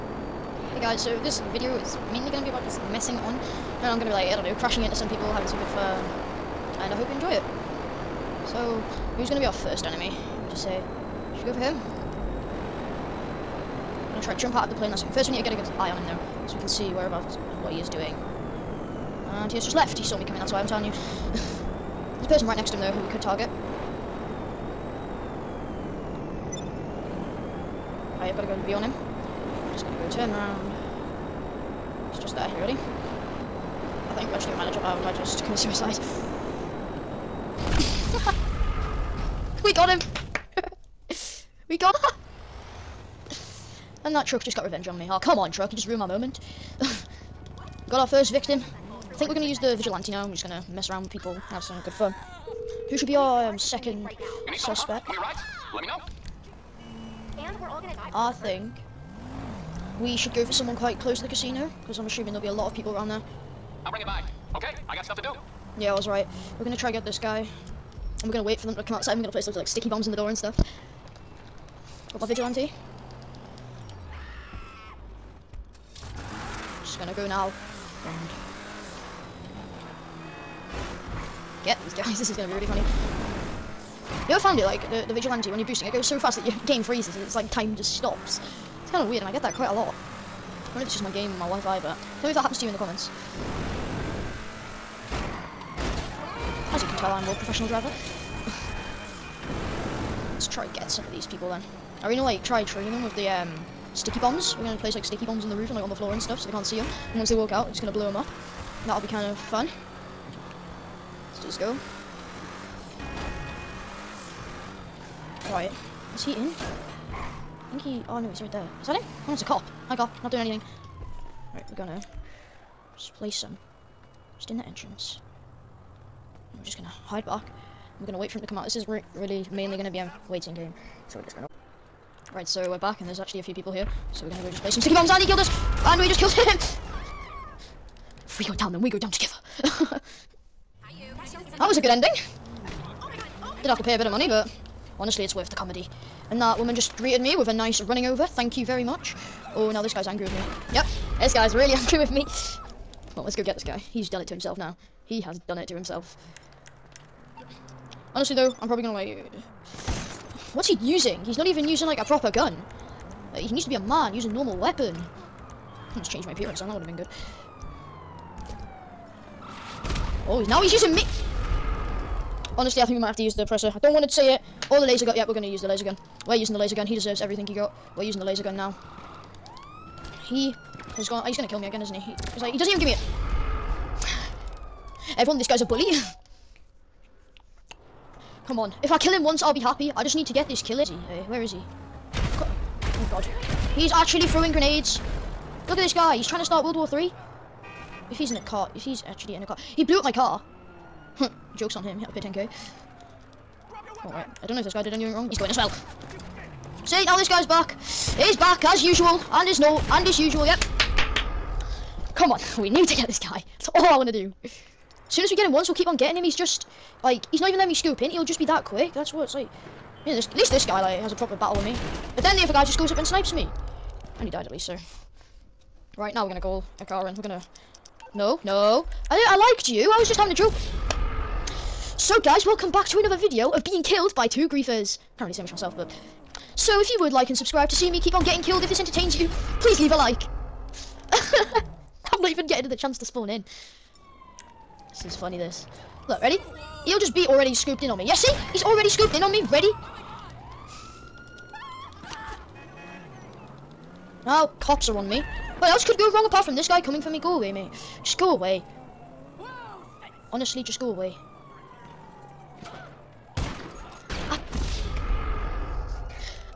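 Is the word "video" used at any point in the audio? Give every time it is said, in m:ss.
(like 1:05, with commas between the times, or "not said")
0:01, 3:53.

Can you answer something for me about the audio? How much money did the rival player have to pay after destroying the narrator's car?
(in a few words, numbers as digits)
10k.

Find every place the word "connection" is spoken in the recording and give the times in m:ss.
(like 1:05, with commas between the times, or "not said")
not said.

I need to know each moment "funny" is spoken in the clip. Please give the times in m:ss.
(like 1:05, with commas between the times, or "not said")
1:22, 4:05.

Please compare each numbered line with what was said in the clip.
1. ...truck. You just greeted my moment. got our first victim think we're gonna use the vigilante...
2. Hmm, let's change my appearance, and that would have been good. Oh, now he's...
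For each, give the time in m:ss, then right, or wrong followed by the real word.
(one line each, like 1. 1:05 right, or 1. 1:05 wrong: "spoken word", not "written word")
1. 0:45 wrong: "ruined", not "greeted"
2. 2:44 right.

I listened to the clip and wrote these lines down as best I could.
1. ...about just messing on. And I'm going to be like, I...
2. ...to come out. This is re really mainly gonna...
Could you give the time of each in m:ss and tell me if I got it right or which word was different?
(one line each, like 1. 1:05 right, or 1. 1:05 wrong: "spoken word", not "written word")
1. 0:02 right
2. 2:08 right.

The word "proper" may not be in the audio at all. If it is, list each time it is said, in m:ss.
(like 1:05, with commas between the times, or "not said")
2:42, 3:41.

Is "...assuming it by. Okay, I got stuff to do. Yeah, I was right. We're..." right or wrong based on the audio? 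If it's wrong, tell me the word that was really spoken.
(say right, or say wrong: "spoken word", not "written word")
wrong: "bring", not "assuming".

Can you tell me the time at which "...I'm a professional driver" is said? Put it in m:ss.
1:37.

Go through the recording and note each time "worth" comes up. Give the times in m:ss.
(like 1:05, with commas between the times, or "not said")
2:25.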